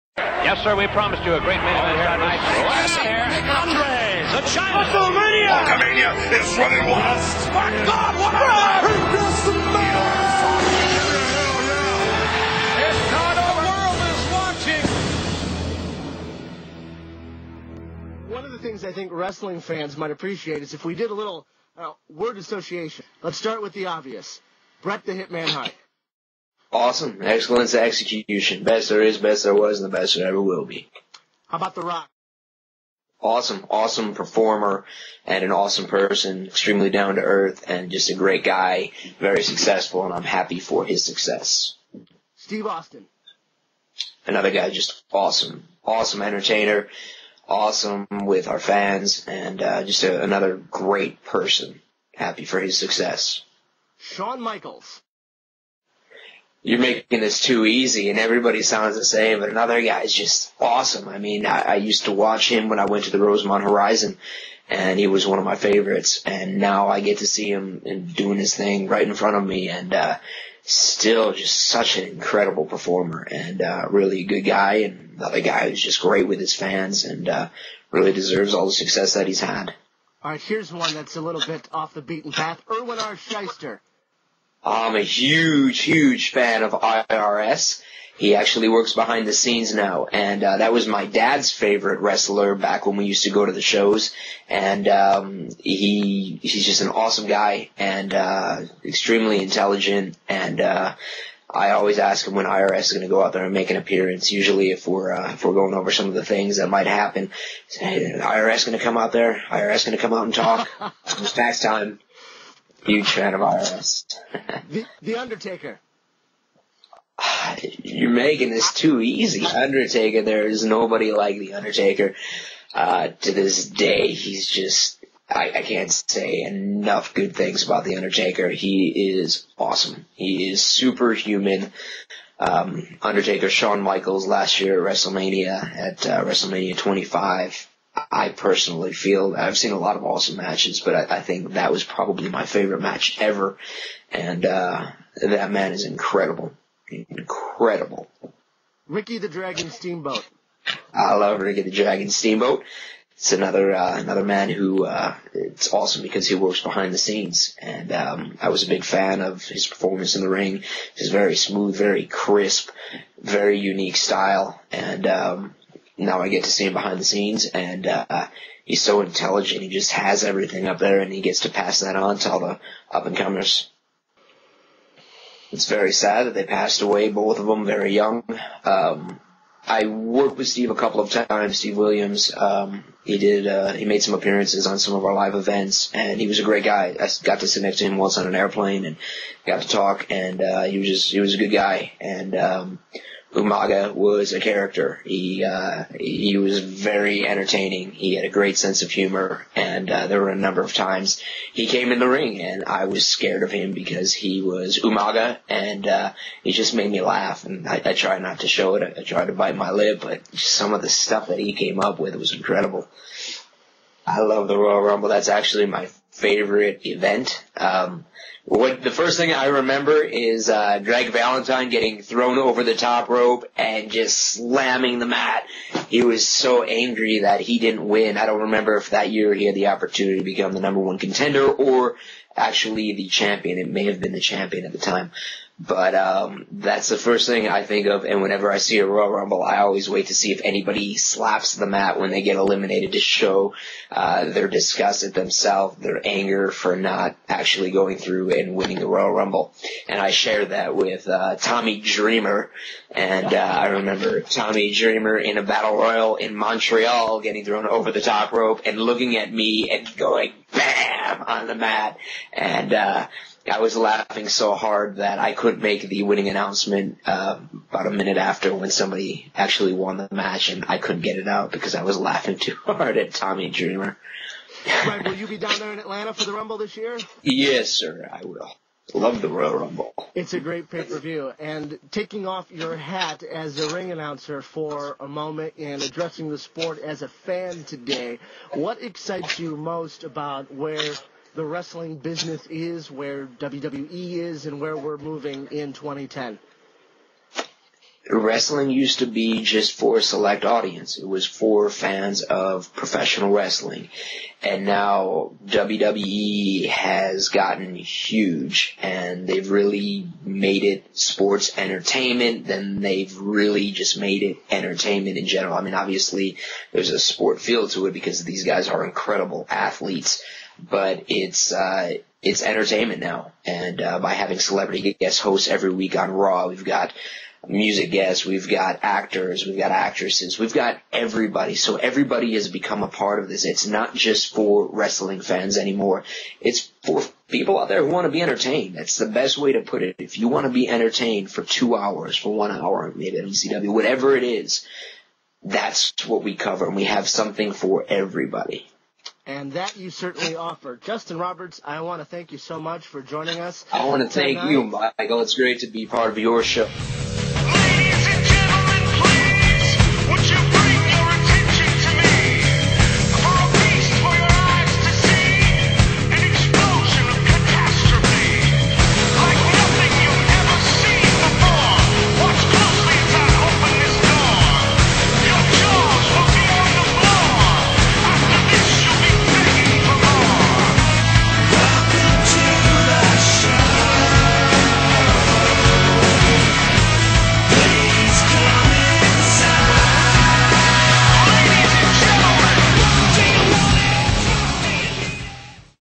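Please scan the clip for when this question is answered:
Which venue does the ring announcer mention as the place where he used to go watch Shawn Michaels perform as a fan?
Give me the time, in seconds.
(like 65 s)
63 s.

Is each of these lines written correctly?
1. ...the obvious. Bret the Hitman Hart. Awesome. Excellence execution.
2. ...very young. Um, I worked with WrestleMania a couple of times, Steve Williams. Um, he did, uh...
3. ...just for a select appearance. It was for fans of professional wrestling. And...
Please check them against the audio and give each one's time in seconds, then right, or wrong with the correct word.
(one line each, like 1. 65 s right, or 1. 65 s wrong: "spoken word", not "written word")
1. 23 s right
2. 177 s wrong: "Steve", not "WrestleMania"
3. 299 s wrong: "audience", not "appearance".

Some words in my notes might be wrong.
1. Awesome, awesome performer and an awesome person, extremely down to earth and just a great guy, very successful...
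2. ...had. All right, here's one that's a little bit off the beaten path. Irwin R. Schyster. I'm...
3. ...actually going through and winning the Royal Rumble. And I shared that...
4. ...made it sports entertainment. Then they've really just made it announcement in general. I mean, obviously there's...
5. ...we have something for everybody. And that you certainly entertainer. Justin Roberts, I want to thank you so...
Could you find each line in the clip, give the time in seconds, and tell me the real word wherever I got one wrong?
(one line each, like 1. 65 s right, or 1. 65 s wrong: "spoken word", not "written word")
1. 33 s right
2. 79 s right
3. 247 s right
4. 310 s wrong: "entertainment", not "announcement"
5. 346 s wrong: "offer", not "entertainer".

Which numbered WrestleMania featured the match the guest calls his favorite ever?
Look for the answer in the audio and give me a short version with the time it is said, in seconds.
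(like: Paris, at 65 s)
WrestleMania 25, at 136 s.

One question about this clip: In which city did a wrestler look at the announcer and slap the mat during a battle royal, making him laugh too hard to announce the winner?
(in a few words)
Montreal.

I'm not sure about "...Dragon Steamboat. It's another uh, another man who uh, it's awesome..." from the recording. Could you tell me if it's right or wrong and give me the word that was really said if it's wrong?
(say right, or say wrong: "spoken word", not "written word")
right.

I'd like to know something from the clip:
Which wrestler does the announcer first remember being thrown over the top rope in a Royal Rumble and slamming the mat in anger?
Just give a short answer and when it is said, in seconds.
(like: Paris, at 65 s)
Greg Valentine, at 220 s.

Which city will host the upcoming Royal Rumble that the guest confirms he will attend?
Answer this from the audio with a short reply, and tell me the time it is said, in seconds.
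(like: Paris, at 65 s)
Atlanta, at 275 s.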